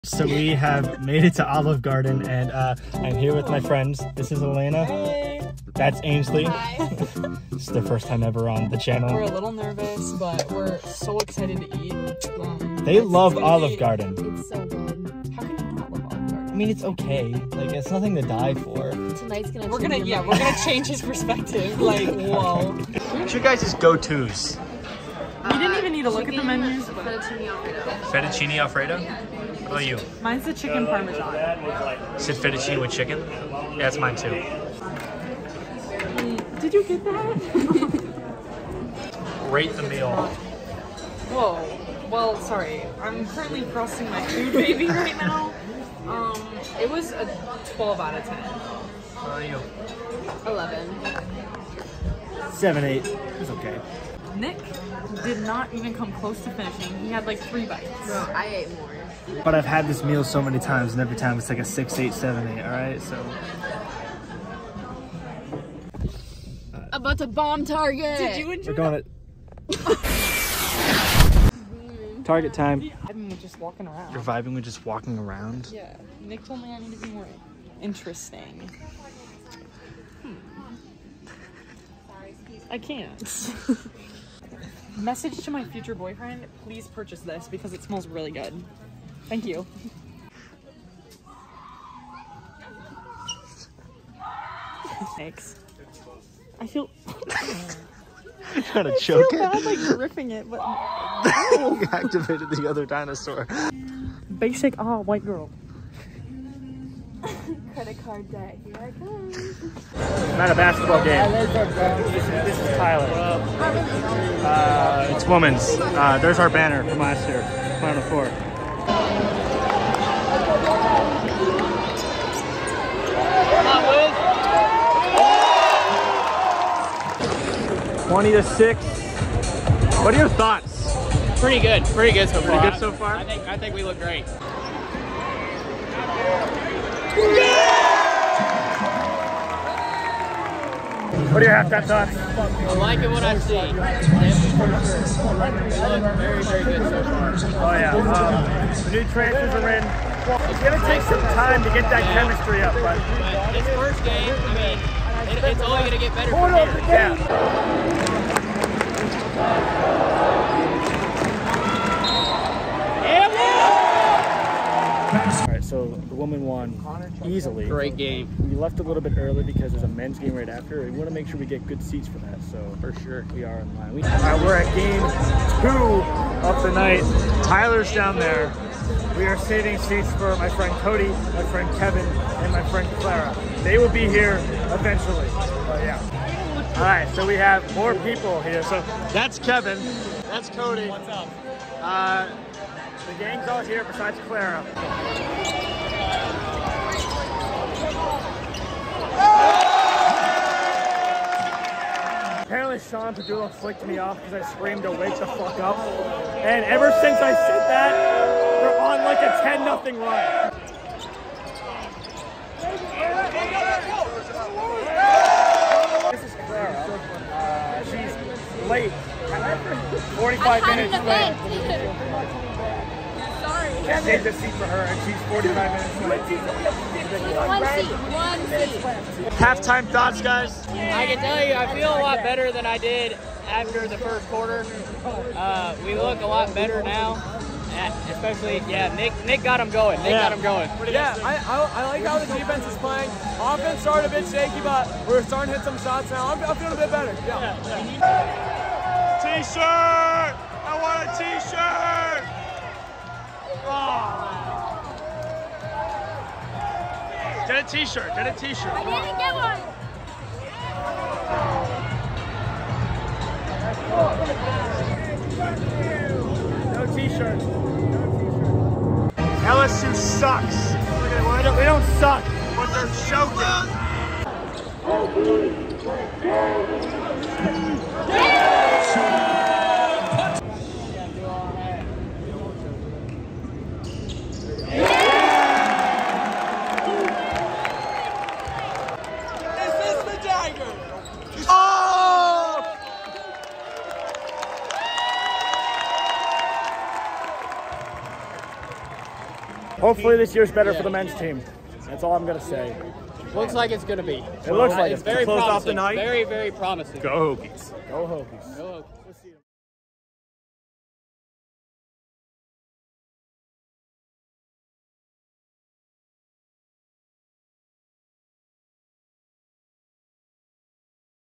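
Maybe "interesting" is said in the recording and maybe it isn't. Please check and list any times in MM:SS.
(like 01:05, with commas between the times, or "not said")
01:17.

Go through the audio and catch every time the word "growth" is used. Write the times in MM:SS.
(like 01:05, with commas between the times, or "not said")
not said.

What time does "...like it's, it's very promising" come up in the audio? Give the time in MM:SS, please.
05:04.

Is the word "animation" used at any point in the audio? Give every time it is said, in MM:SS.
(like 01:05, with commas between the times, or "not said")
not said.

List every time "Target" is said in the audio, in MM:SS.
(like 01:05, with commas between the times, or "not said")
01:07, 01:12.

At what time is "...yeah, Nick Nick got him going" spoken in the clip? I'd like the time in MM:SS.
03:58.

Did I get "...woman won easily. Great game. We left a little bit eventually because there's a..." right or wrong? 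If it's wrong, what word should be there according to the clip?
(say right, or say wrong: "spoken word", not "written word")
wrong: "early", not "eventually".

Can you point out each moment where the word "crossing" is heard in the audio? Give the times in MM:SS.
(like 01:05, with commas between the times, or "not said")
00:43.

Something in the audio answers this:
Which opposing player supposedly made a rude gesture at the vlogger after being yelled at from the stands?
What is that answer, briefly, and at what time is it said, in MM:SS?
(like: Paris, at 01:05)
Sean Pedulla, at 03:22.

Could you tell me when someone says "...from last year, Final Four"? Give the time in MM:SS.
01:56.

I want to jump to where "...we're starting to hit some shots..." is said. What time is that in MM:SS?
04:05.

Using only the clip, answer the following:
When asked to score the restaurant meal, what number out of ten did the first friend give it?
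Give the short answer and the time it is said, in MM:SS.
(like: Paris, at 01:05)
12, at 00:47.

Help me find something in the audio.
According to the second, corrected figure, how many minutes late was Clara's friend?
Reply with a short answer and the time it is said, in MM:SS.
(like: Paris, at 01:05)
49, at 03:45.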